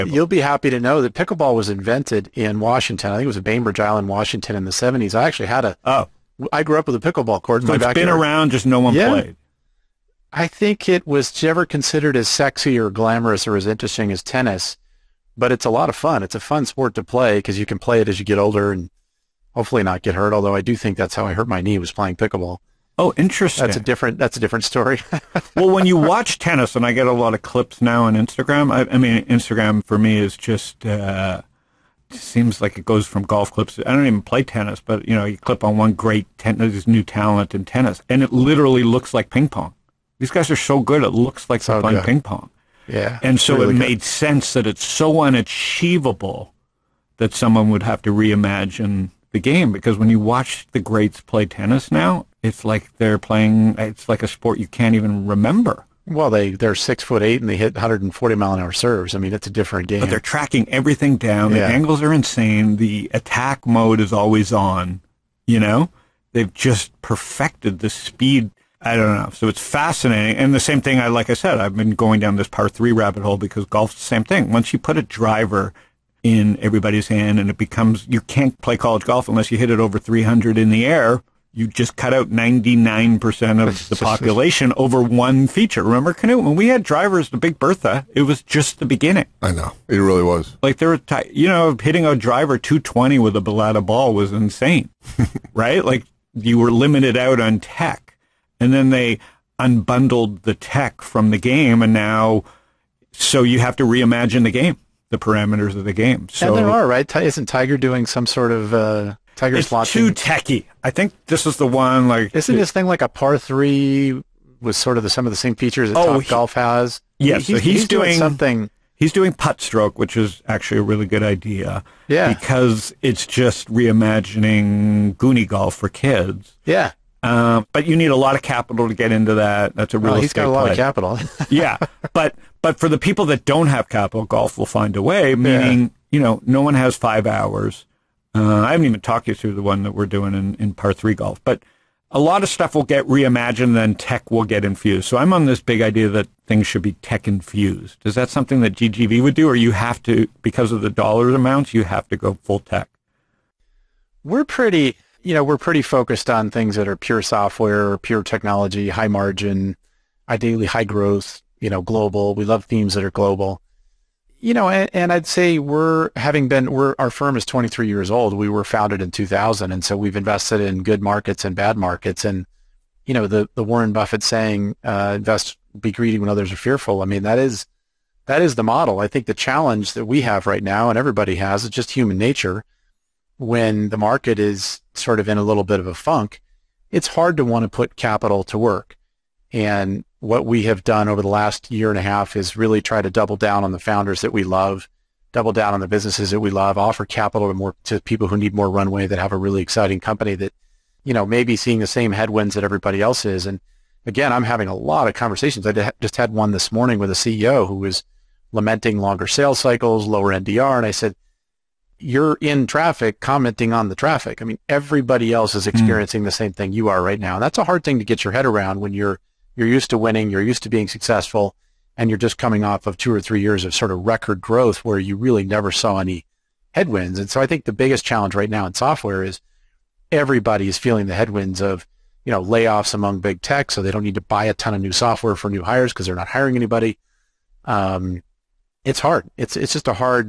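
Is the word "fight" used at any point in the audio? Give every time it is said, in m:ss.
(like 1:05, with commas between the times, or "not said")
not said.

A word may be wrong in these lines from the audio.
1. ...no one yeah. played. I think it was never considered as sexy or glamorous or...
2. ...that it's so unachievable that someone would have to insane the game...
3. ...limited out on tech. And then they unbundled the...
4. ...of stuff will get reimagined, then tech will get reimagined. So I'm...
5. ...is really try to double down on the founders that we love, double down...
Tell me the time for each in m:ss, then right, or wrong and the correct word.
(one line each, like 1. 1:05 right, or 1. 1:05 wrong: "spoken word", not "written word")
1. 0:08 right
2. 0:44 wrong: "reimagine", not "insane"
3. 1:36 right
4. 2:22 wrong: "infused", not "reimagined"
5. 3:12 right.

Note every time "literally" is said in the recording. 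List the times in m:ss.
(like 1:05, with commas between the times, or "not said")
0:38.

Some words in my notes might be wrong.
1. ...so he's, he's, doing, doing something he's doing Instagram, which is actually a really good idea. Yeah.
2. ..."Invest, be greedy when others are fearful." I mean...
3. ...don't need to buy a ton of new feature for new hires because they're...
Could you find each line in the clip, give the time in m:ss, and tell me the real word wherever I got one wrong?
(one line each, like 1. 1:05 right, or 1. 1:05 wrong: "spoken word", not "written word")
1. 1:57 wrong: "PopStroke", not "Instagram"
2. 2:55 right
3. 3:53 wrong: "software", not "feature".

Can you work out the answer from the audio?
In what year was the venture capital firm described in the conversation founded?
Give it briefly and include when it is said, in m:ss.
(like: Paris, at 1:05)
2000, at 2:49.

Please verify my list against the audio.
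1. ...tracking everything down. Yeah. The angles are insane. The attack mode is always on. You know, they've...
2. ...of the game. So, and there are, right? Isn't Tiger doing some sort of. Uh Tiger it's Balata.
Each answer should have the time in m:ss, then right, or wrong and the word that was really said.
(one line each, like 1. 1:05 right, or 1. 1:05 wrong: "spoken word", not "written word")
1. 1:00 right
2. 1:45 wrong: "Slot", not "Balata".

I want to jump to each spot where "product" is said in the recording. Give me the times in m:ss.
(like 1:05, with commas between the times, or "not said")
not said.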